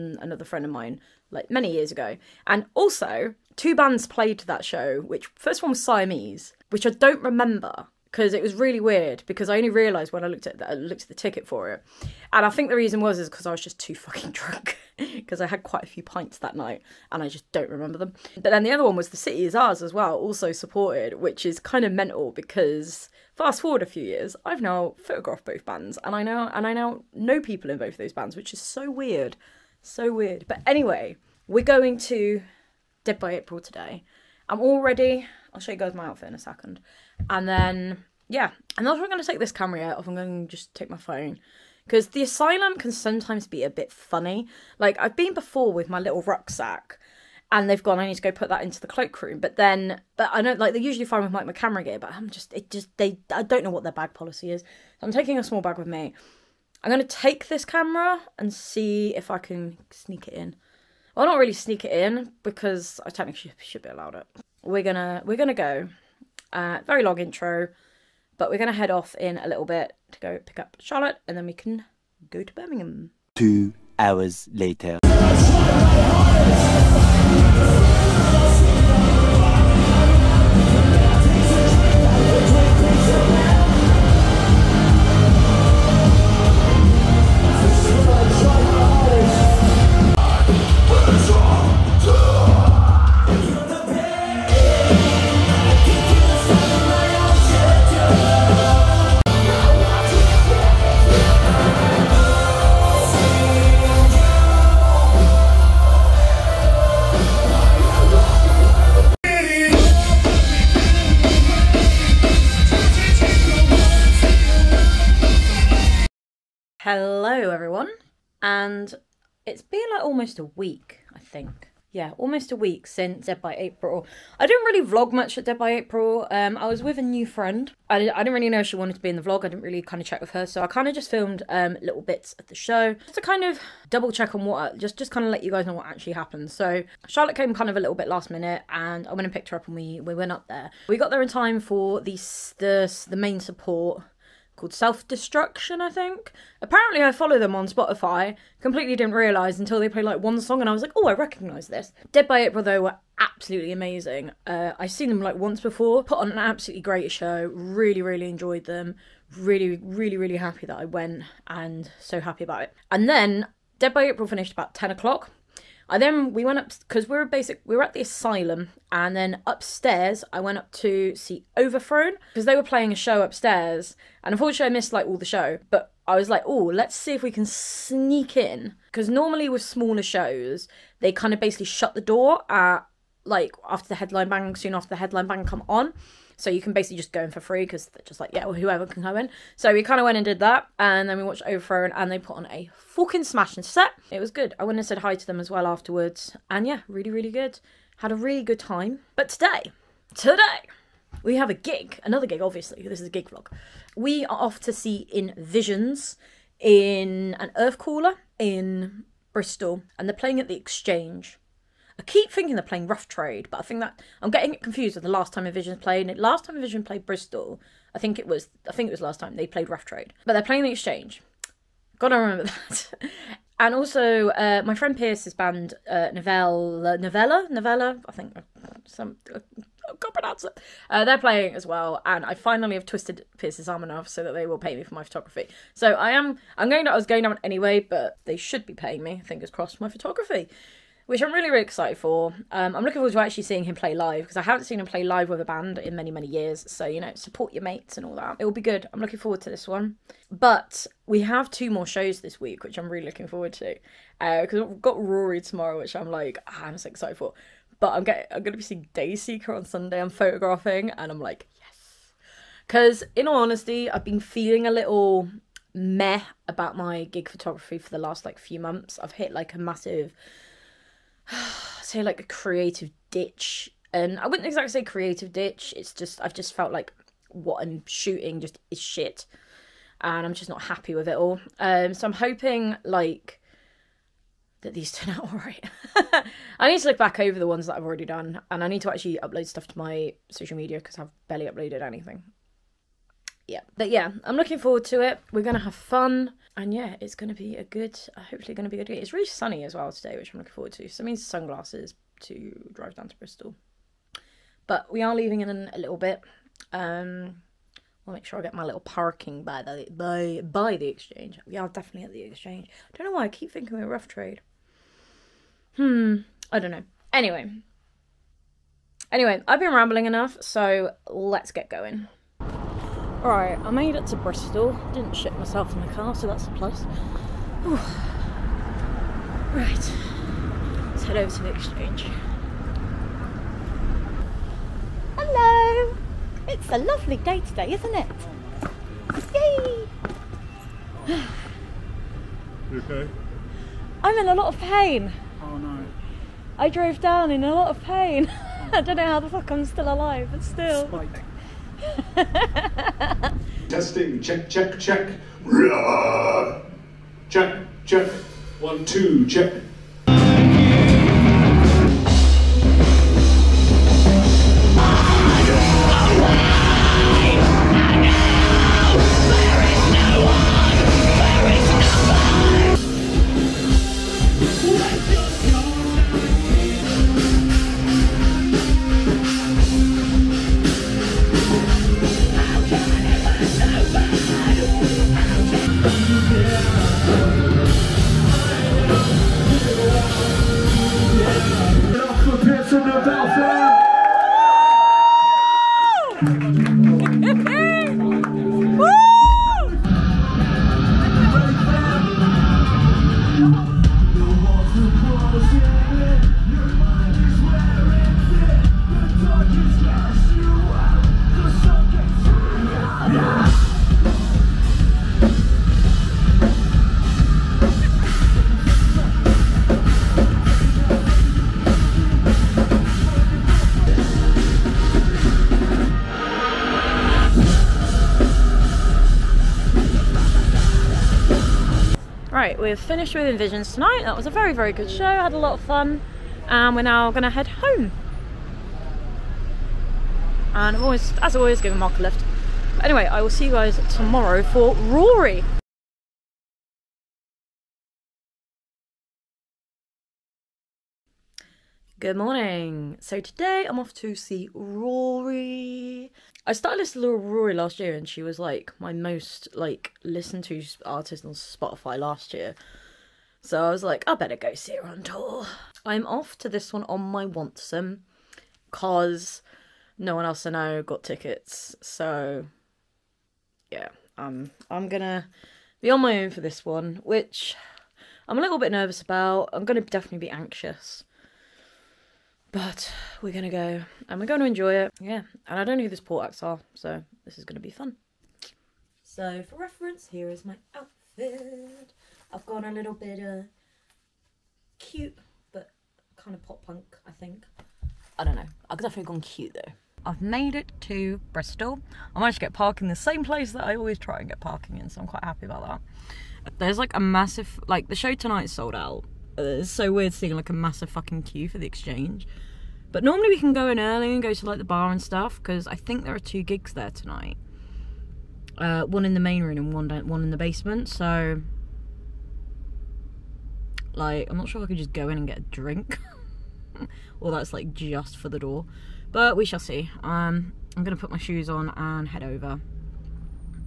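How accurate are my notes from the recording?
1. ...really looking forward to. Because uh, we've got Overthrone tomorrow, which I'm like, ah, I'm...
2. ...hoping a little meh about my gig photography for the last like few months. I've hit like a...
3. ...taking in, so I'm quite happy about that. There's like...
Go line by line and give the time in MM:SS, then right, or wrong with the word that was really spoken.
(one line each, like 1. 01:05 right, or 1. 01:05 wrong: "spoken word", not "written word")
1. 04:12 wrong: "Rory", not "Overthrone"
2. 04:24 wrong: "feeling", not "hoping"
3. 08:24 wrong: "parking", not "taking".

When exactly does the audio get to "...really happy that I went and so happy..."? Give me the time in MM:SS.
02:40.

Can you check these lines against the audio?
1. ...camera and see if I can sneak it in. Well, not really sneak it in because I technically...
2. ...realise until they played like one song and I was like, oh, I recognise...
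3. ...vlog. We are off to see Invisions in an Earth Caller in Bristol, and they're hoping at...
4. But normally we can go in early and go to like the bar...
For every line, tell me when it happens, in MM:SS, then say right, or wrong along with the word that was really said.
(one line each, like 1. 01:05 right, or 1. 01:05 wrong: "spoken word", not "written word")
1. 00:57 right
2. 02:29 right
3. 03:23 wrong: "playing", not "hoping"
4. 08:32 right.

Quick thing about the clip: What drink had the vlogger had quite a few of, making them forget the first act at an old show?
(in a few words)
pints.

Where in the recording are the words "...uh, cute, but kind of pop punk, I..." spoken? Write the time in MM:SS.
08:13.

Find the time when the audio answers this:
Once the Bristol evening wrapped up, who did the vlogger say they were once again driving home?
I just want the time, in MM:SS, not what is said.
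07:21.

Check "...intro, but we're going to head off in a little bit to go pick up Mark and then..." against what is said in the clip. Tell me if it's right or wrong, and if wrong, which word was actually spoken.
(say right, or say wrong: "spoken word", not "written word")
wrong: "Charlotte", not "Mark".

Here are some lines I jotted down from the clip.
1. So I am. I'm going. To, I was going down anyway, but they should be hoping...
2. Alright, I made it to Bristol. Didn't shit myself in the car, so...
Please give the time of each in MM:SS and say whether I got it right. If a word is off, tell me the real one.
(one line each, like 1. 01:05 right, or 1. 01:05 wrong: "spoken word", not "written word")
1. 03:55 wrong: "paying", not "hoping"
2. 05:23 right.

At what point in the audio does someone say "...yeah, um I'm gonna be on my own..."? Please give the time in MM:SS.
07:53.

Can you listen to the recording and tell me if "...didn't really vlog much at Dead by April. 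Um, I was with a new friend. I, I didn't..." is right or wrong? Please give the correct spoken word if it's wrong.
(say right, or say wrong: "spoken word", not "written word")
right.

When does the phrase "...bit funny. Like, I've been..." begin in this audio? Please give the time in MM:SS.
00:43.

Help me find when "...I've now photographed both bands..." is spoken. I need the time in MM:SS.
00:24.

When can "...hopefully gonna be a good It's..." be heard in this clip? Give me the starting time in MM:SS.
04:58.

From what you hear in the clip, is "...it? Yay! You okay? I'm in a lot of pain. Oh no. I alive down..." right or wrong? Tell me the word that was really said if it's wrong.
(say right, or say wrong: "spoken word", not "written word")
wrong: "drove", not "alive".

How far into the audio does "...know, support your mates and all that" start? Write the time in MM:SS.
04:07.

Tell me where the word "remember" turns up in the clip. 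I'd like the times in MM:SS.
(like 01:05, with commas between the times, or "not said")
00:07, 00:17, 03:42.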